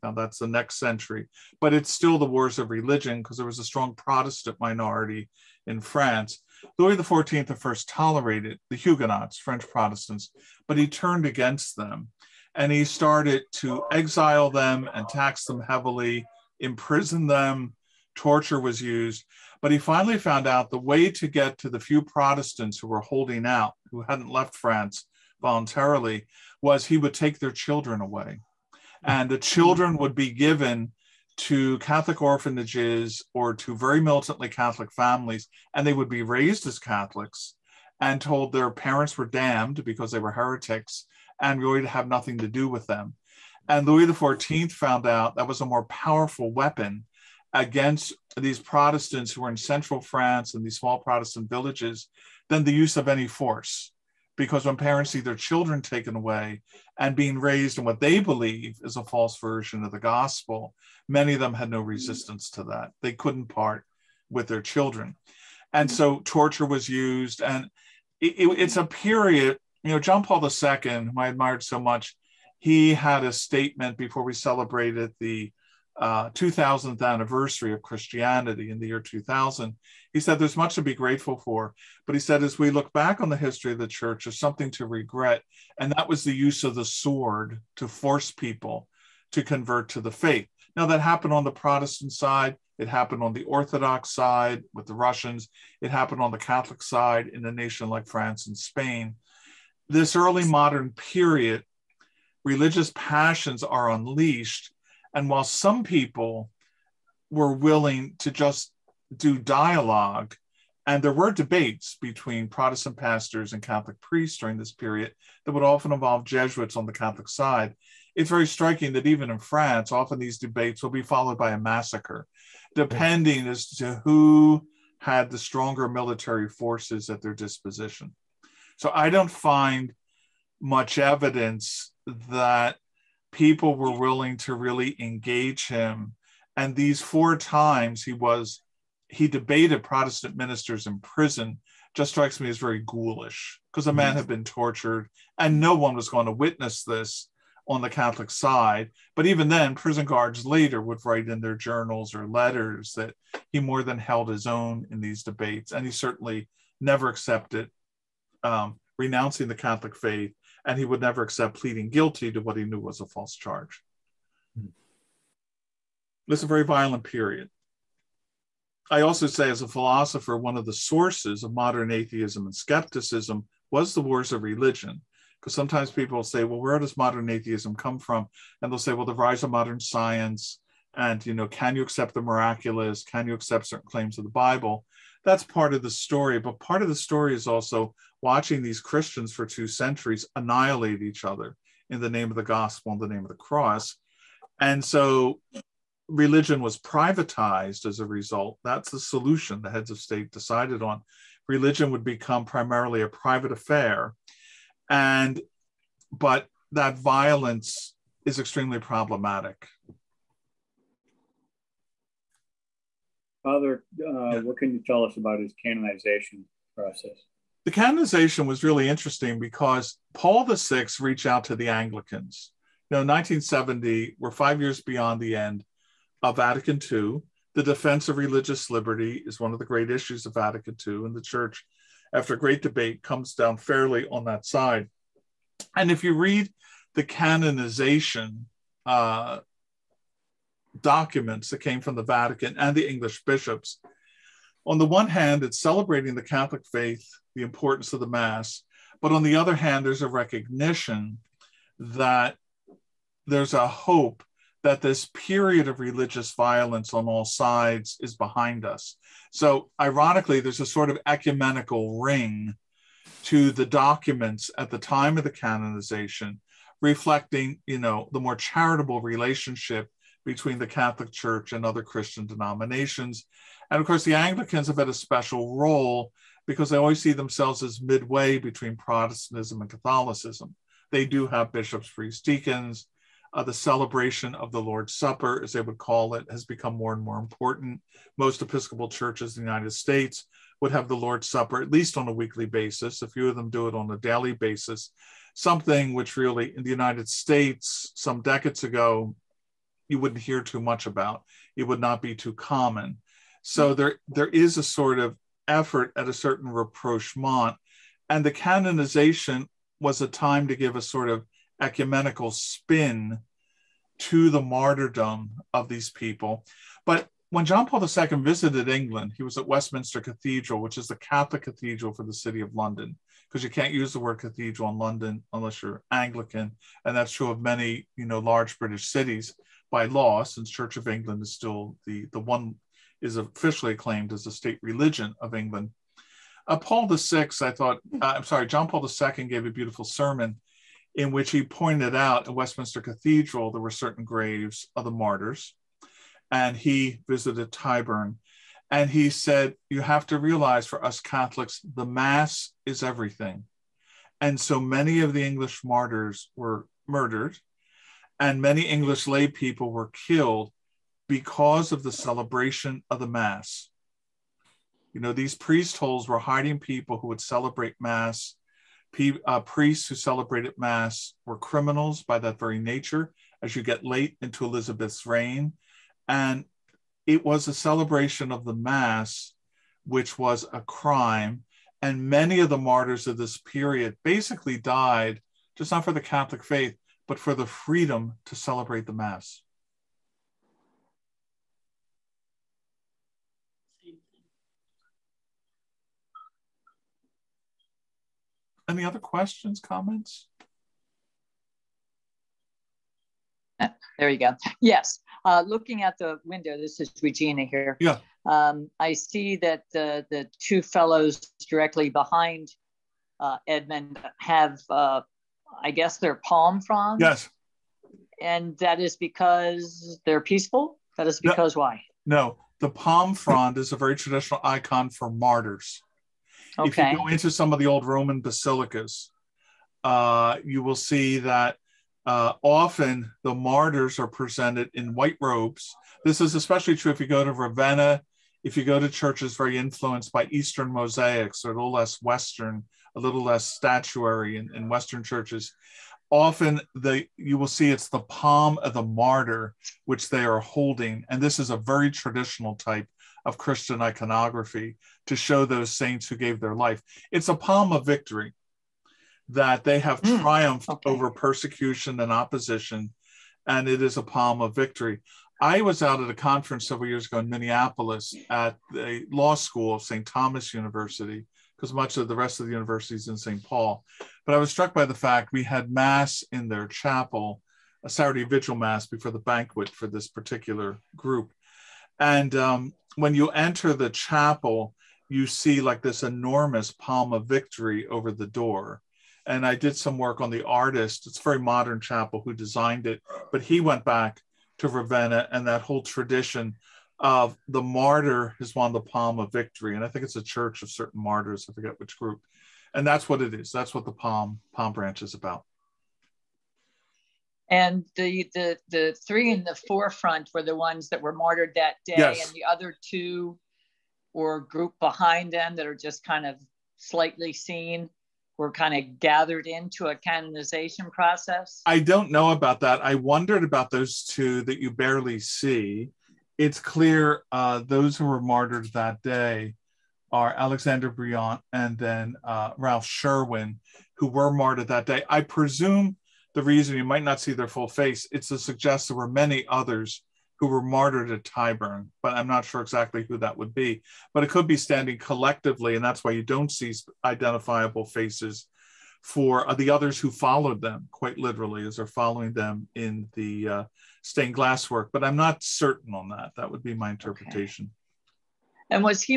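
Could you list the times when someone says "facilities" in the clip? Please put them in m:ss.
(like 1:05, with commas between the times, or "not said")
not said.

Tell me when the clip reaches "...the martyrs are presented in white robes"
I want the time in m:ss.
7:13.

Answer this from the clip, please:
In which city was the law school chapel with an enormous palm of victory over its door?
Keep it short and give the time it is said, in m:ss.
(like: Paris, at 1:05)
Minneapolis, at 7:47.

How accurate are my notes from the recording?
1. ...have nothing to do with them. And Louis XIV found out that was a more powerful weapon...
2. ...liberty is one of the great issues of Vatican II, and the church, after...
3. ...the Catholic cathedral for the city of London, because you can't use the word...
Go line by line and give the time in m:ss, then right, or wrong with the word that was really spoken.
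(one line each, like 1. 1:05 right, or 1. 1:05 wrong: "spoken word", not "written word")
1. 0:41 right
2. 3:48 right
3. 5:20 right.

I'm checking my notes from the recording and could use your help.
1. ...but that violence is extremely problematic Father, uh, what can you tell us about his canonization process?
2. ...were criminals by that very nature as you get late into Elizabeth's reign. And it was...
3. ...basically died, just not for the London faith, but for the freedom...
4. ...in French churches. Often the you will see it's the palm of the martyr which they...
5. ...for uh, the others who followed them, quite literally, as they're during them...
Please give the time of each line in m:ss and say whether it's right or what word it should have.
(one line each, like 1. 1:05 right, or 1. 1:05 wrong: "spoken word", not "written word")
1. 3:26 right
2. 6:11 right
3. 6:24 wrong: "Catholic", not "London"
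4. 7:24 wrong: "Western", not "French"
5. 9:09 wrong: "following", not "during".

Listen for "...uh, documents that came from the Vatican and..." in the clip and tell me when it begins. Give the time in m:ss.
3:58.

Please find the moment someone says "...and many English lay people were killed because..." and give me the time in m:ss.
5:58.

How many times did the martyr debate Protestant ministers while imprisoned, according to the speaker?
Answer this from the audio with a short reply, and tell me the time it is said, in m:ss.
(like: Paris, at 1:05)
4, at 2:17.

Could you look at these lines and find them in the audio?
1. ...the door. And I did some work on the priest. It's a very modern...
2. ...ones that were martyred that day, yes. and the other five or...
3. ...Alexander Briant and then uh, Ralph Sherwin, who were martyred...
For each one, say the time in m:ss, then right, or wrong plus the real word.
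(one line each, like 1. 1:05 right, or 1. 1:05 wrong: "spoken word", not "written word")
1. 8:08 wrong: "artist", not "priest"
2. 8:30 wrong: "two", not "five"
3. 8:50 right.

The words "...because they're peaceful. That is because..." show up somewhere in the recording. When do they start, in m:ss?
6:58.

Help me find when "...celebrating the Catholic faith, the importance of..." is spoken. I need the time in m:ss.
4:05.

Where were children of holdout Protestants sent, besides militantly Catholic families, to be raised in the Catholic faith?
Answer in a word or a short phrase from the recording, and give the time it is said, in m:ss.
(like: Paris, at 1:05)
Catholic orphanages, at 0:31.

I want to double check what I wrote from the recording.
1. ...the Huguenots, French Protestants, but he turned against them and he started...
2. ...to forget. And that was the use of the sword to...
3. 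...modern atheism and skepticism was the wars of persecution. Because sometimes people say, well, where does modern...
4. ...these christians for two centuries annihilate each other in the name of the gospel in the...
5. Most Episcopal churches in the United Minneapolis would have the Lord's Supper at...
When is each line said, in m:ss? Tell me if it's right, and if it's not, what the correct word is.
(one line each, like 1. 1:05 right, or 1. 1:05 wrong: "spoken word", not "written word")
1. 0:08 right
2. 1:24 wrong: "regret", not "forget"
3. 2:51 wrong: "religion", not "persecution"
4. 3:08 right
5. 4:48 wrong: "States", not "Minneapolis".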